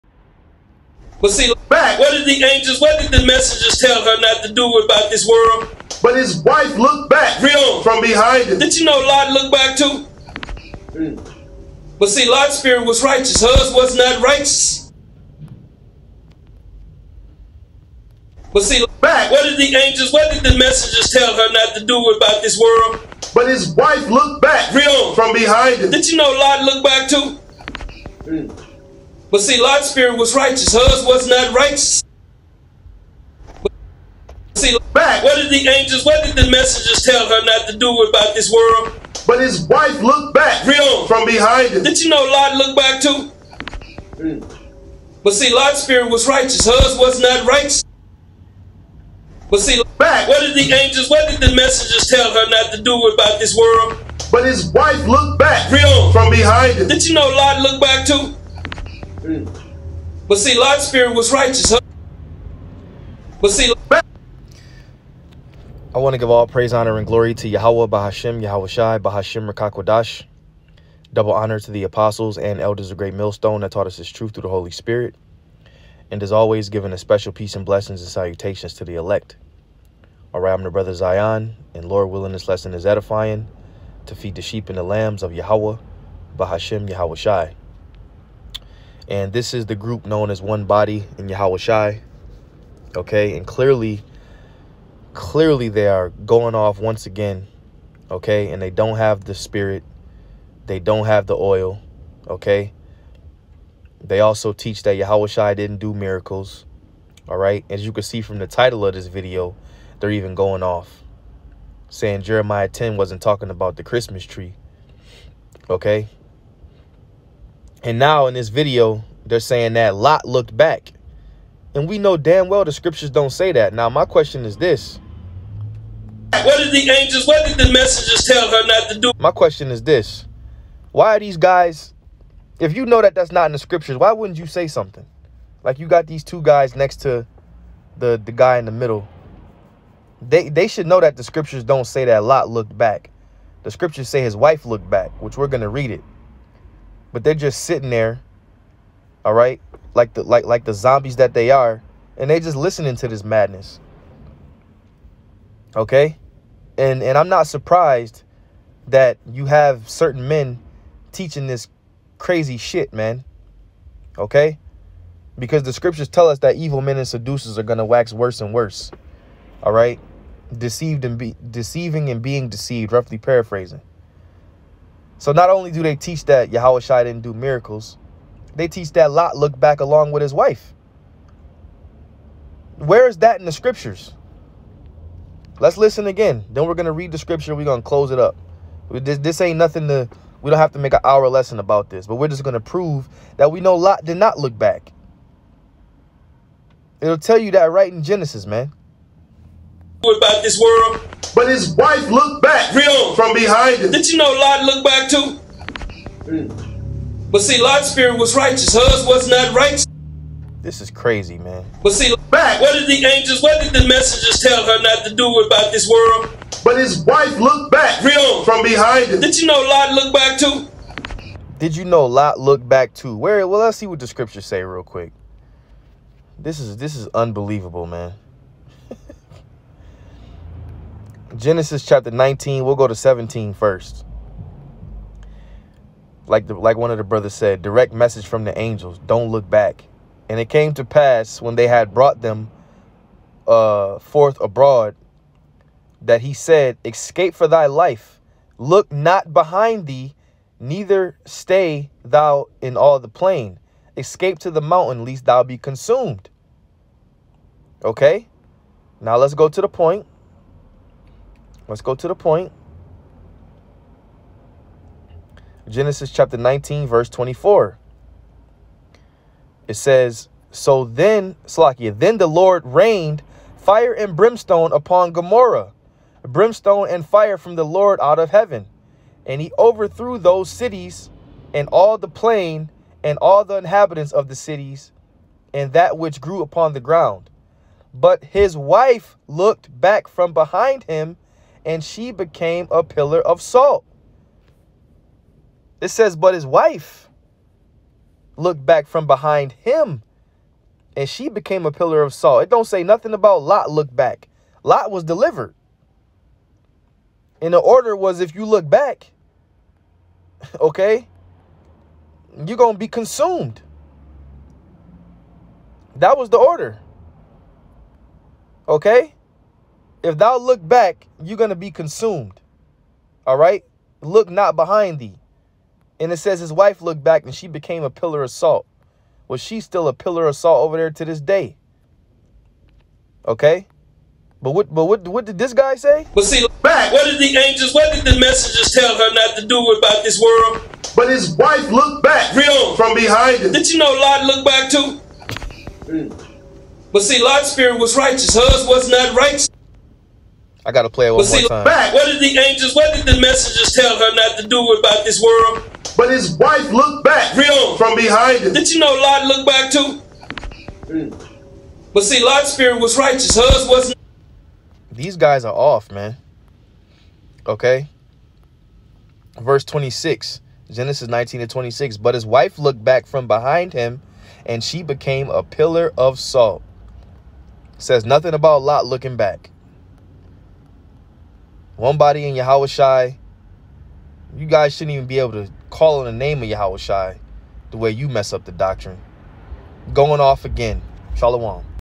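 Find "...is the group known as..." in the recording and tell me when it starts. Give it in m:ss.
1:29.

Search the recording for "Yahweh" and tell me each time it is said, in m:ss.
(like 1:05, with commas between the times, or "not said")
1:07, 1:25.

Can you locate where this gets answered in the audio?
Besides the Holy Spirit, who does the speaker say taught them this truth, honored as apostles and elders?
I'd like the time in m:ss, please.
1:12.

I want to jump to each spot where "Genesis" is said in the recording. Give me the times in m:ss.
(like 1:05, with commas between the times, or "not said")
3:18, 3:51, 4:25, 6:10.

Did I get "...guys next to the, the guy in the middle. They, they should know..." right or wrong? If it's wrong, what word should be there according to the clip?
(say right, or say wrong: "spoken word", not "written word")
right.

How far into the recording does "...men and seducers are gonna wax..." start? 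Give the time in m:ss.
2:46.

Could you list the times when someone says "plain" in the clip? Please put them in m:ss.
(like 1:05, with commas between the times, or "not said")
4:13, 4:42.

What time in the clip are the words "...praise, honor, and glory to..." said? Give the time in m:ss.
1:06.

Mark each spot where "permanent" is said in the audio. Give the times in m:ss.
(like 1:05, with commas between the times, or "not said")
not said.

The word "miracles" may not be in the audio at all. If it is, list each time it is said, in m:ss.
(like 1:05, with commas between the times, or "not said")
1:45, 2:57.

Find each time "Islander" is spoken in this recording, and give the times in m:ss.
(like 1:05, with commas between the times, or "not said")
not said.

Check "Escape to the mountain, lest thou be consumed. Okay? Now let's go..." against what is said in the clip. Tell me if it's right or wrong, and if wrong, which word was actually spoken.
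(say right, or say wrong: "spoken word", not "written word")
right.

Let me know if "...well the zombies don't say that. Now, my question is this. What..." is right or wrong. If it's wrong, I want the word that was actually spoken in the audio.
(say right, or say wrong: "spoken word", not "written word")
wrong: "scriptures", not "zombies".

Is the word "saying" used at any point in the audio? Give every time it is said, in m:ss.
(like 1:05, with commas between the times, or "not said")
1:51, 1:59.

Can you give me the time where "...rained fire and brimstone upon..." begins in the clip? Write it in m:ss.
4:32.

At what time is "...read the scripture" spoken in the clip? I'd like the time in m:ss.
3:06.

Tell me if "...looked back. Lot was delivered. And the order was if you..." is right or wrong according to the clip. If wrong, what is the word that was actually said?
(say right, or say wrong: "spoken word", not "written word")
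right.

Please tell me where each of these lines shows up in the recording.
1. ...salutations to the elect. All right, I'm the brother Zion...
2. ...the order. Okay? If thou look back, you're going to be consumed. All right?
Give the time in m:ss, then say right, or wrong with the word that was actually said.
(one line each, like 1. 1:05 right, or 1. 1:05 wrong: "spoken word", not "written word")
1. 1:18 right
2. 5:16 right.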